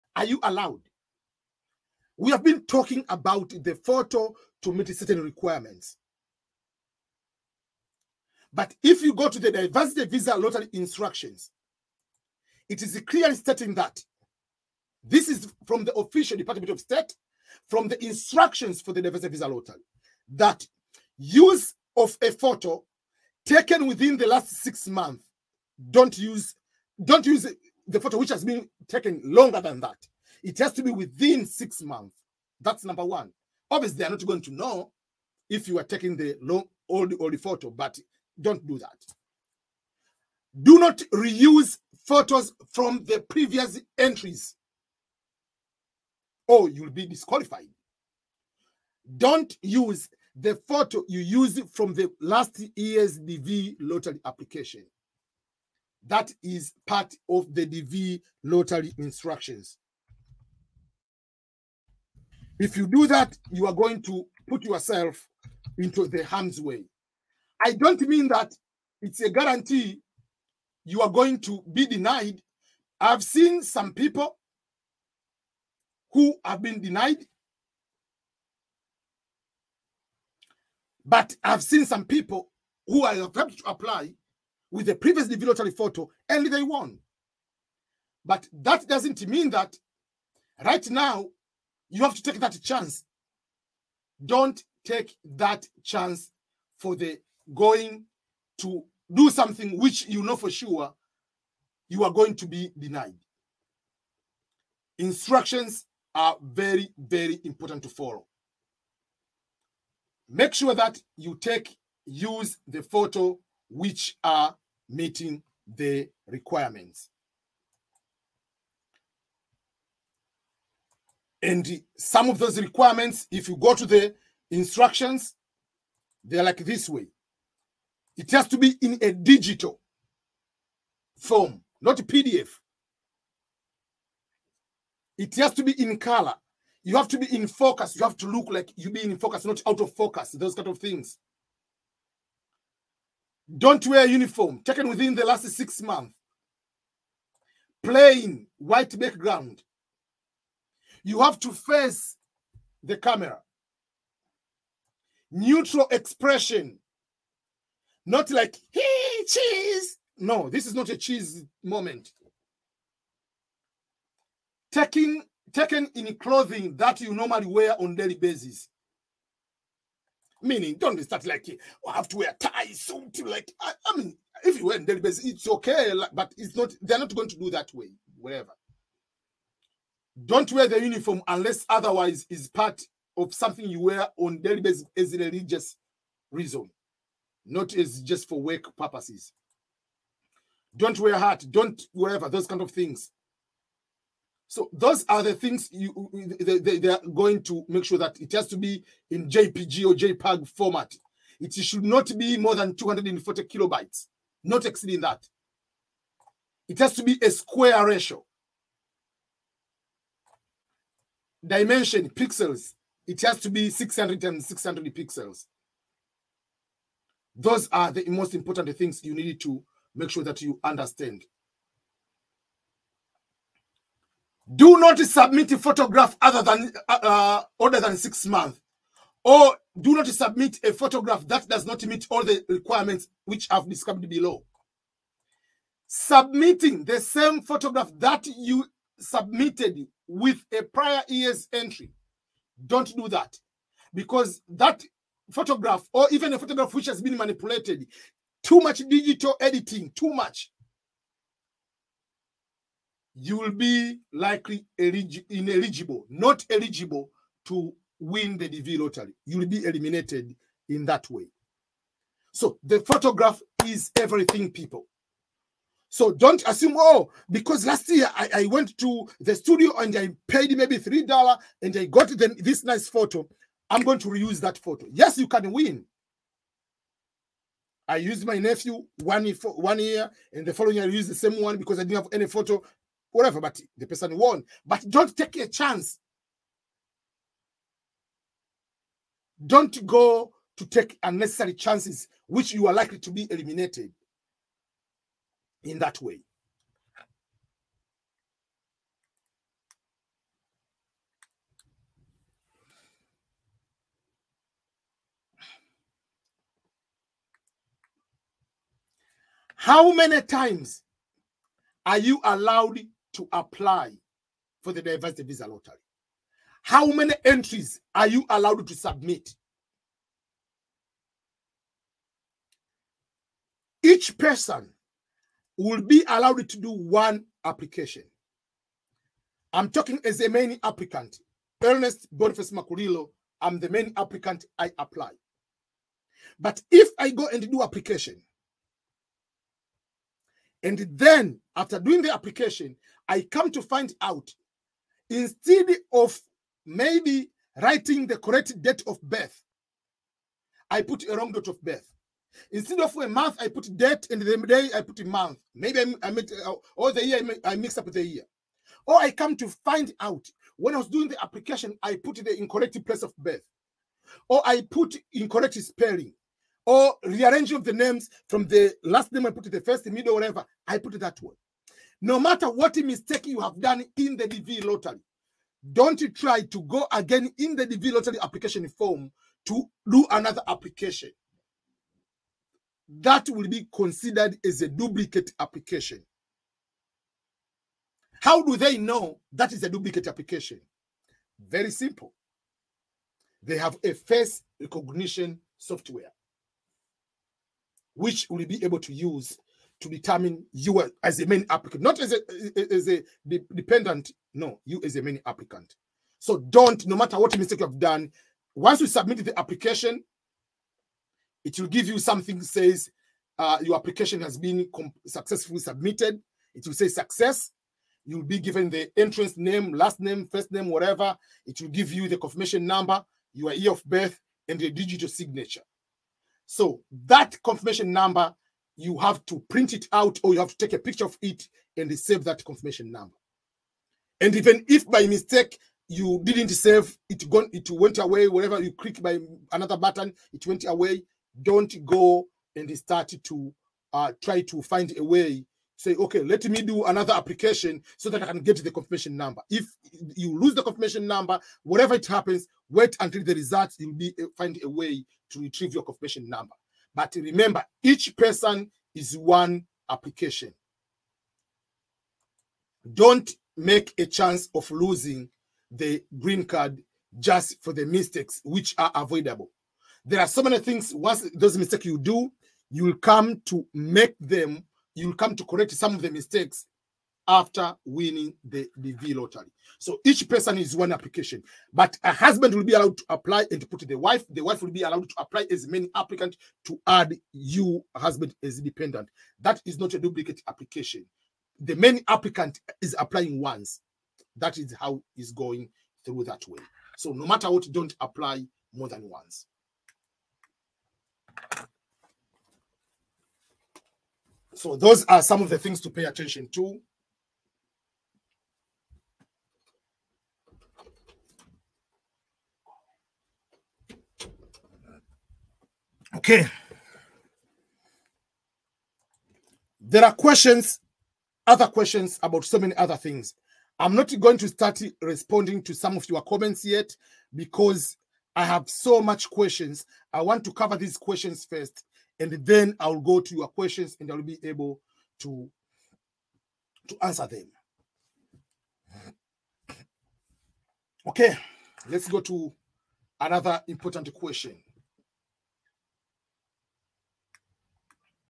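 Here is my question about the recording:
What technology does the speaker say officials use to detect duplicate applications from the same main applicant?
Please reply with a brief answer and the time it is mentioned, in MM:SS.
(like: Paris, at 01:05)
Face recognition software, at 06:33.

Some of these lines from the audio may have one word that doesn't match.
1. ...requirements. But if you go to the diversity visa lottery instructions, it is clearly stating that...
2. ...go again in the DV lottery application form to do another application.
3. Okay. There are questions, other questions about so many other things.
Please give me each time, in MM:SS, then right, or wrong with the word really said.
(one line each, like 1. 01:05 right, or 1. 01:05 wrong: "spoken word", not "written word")
1. 00:05 right
2. 06:16 right
3. 08:36 right.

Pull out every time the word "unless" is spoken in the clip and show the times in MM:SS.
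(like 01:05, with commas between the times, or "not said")
03:01.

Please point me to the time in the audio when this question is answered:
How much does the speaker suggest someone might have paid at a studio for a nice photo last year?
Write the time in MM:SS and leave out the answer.
04:30.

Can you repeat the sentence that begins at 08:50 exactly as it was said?
I want to cover these questions first and then I'll go to your questions and I'll be able to to answer them.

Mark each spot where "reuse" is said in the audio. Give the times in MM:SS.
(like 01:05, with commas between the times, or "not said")
00:41, 04:34.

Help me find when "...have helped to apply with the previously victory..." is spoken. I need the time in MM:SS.
01:23.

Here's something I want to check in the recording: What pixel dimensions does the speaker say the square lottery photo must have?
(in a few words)
600 by 600 pixels.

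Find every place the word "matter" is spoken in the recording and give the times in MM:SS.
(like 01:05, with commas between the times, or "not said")
06:12, 06:46, 08:17.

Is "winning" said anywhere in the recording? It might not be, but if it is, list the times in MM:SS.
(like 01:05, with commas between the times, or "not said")
07:57.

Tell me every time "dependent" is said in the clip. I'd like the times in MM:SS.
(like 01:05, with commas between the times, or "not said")
06:43, 08:08.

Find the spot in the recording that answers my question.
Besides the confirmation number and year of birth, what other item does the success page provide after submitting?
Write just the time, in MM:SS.
07:04.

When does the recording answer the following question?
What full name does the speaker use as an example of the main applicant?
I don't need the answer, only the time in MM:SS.
05:31.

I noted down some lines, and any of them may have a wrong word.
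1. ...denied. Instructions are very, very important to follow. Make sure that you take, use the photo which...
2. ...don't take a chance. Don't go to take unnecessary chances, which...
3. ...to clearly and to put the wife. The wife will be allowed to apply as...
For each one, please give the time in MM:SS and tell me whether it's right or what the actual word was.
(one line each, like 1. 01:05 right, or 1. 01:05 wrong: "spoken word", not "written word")
1. 01:42 right
2. 04:44 right
3. 08:02 wrong: "apply", not "clearly".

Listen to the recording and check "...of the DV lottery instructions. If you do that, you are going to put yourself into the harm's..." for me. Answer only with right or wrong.
right.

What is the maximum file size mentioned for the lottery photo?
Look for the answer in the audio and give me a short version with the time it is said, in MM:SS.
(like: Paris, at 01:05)
240 kilobytes, at 03:22.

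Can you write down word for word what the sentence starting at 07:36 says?
But remember, each person is one application.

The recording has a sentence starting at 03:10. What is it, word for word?
Don't wear hat, don't whatever, those kind of things.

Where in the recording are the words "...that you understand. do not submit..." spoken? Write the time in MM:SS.
03:40.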